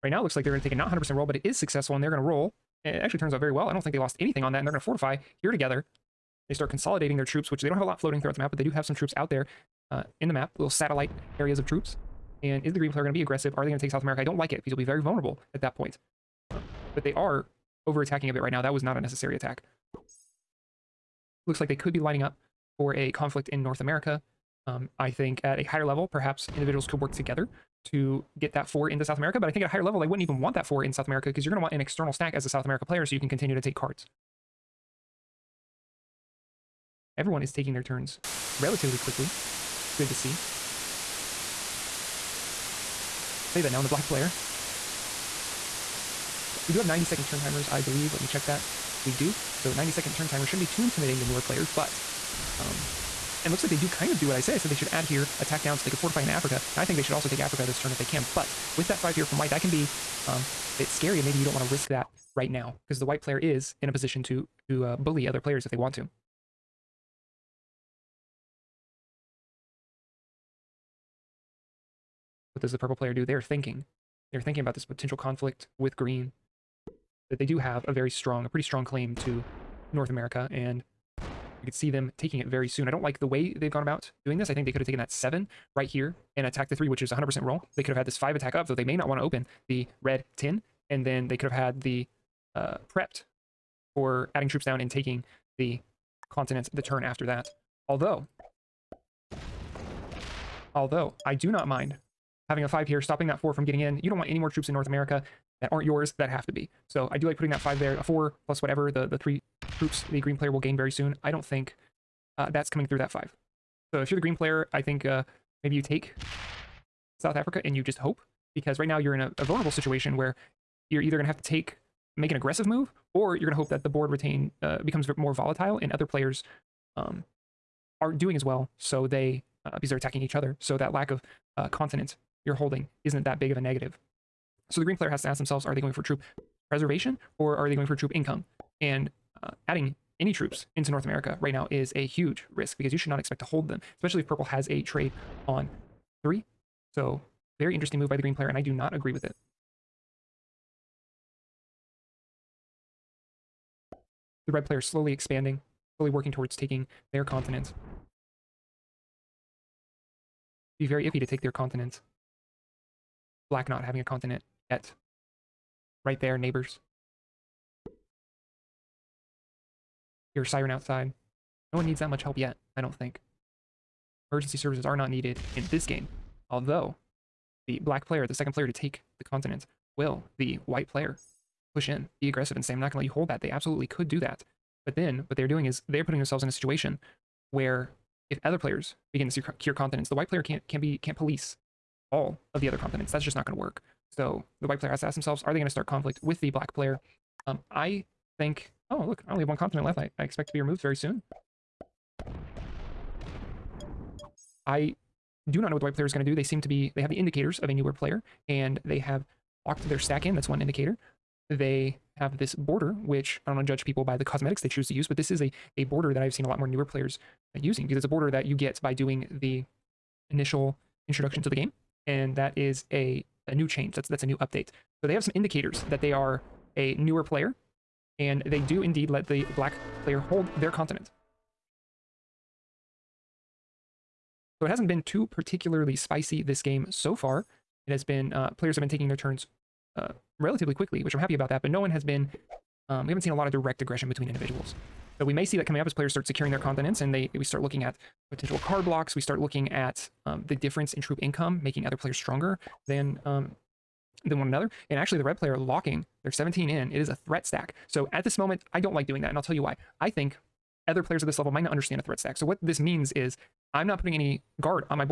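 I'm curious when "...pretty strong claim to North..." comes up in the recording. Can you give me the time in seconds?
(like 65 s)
78 s.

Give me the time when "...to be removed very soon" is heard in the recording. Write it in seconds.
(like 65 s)
200 s.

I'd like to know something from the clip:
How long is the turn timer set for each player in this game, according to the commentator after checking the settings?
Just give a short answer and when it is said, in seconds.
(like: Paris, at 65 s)
90 seconds, at 46 s.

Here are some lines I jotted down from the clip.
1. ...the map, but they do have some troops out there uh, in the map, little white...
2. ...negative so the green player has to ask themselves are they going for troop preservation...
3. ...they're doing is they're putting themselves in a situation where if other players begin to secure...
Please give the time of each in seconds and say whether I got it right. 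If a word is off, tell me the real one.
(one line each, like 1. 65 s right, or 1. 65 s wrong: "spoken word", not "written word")
1. 8 s wrong: "satellite", not "white"
2. 133 s right
3. 185 s right.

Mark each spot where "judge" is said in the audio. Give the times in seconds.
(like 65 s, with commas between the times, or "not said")
213 s.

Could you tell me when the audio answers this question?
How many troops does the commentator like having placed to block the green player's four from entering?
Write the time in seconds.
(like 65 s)
102 s.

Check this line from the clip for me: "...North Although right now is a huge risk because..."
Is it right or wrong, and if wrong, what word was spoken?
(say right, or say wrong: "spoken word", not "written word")
wrong: "America", not "Although".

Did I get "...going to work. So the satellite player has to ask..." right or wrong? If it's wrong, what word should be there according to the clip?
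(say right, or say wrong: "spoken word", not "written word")
wrong: "white", not "satellite".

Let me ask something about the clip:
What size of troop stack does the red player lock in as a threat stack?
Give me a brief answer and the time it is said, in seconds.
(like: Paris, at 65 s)
17, at 256 s.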